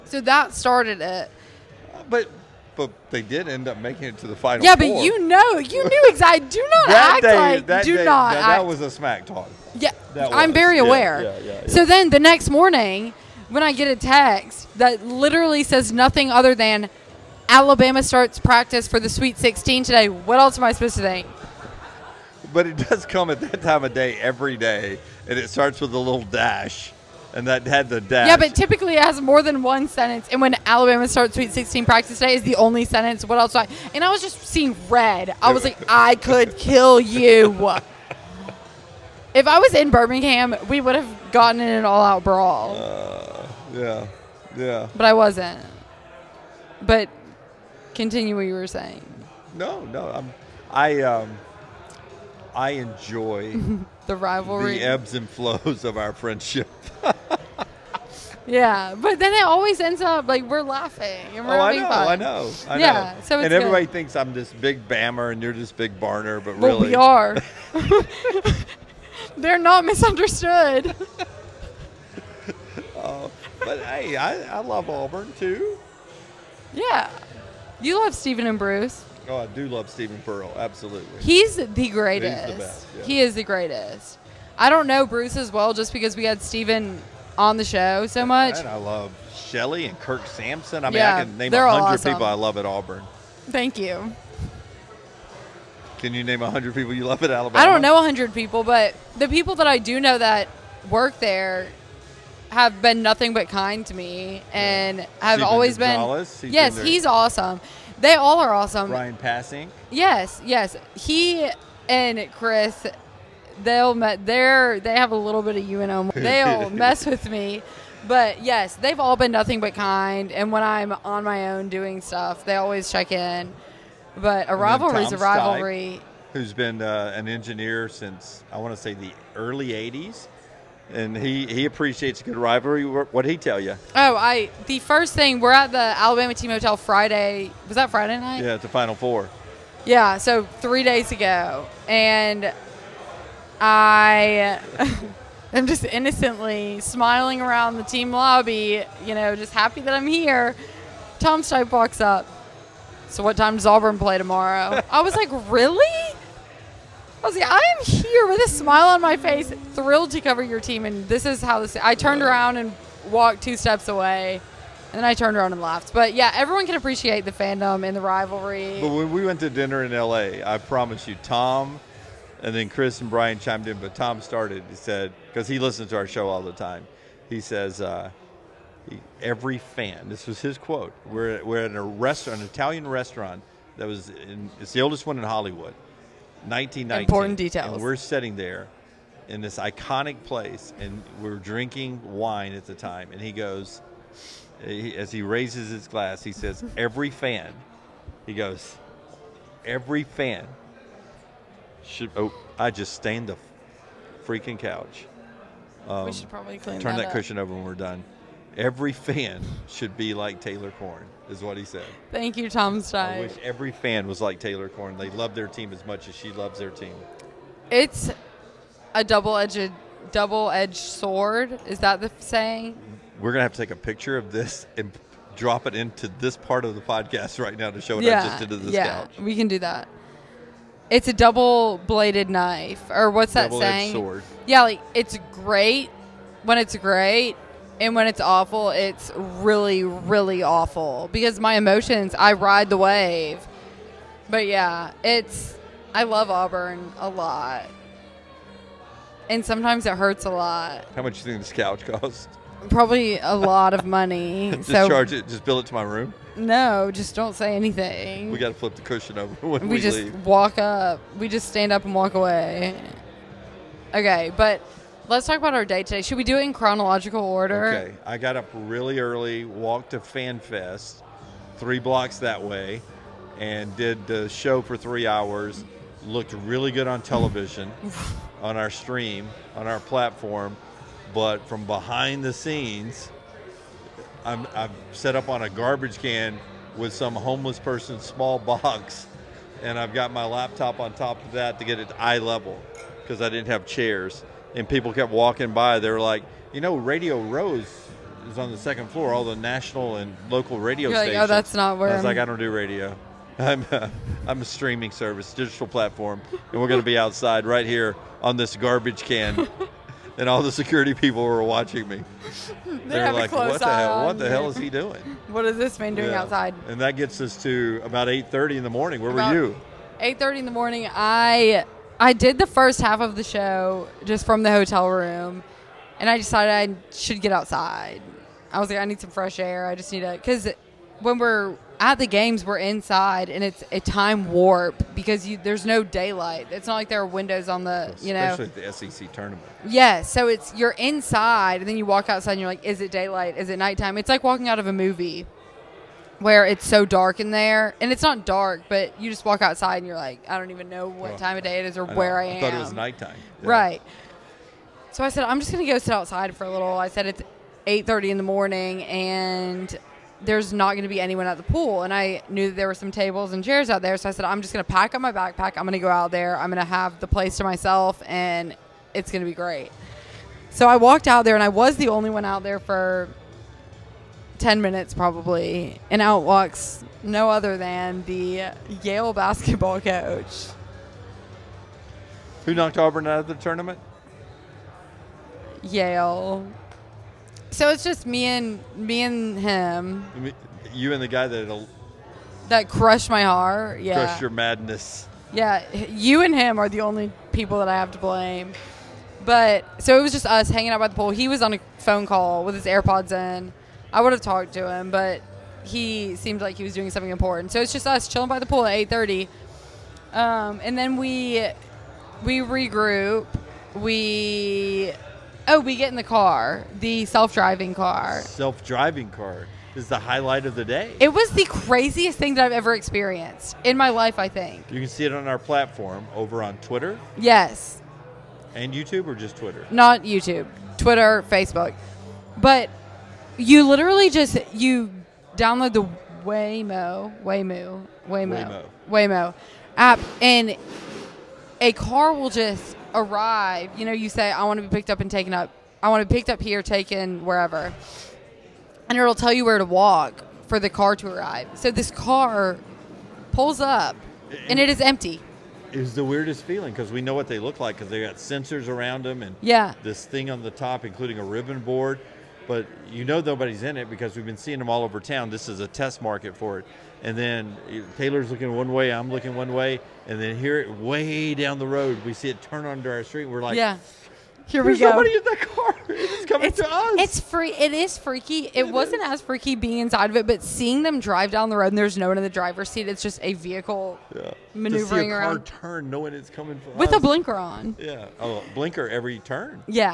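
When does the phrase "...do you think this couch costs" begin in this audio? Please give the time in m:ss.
4:11.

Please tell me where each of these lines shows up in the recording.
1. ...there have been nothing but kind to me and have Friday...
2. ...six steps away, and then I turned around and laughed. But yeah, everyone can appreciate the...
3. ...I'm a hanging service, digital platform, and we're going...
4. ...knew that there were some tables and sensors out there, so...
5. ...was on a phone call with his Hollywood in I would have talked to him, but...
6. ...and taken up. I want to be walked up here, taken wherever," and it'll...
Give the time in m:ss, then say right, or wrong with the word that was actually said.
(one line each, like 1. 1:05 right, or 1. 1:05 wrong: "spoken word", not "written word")
1. 1:41 wrong: "Stephen", not "Friday"
2. 2:43 wrong: "two", not "six"
3. 5:04 wrong: "streaming", not "hanging"
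4. 6:02 wrong: "chairs", not "sensors"
5. 6:41 wrong: "AirPods", not "Hollywood"
6. 7:24 wrong: "picked", not "walked".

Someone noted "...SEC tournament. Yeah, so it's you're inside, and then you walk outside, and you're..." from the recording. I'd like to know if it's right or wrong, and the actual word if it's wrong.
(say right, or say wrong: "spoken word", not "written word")
right.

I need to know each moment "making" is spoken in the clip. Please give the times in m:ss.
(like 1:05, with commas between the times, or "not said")
0:03.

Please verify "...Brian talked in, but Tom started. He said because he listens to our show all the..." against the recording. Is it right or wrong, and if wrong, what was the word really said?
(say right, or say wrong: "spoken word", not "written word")
wrong: "chimed", not "talked".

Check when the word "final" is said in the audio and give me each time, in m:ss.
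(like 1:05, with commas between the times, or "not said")
0:04, 2:18.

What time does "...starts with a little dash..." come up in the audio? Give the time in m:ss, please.
0:25.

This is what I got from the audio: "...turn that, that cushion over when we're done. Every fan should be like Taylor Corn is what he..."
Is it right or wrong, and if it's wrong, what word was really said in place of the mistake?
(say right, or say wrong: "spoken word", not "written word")
right.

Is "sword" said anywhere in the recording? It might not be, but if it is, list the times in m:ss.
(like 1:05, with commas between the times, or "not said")
3:40, 3:53.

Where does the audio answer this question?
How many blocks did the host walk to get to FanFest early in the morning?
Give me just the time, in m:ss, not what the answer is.
4:31.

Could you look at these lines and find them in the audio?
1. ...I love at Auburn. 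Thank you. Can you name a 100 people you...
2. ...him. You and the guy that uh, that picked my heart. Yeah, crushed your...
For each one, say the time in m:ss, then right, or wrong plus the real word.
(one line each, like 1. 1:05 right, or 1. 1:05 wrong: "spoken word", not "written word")
1. 1:32 right
2. 6:29 wrong: "crushed", not "picked".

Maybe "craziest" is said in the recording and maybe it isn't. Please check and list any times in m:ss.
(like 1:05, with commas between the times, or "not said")
7:01.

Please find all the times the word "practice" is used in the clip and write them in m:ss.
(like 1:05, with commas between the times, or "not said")
0:18, 0:31.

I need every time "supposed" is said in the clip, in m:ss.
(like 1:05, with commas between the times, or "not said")
0:20.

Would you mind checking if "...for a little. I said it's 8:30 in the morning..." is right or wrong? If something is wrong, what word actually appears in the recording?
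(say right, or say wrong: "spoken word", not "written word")
right.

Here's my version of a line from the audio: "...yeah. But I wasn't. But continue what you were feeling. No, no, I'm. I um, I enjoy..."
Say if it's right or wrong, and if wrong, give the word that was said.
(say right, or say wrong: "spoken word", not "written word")
wrong: "saying", not "feeling".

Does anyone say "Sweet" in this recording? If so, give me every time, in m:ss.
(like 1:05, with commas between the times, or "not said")
0:19, 0:31.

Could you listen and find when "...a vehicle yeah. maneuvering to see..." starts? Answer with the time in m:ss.
8:03.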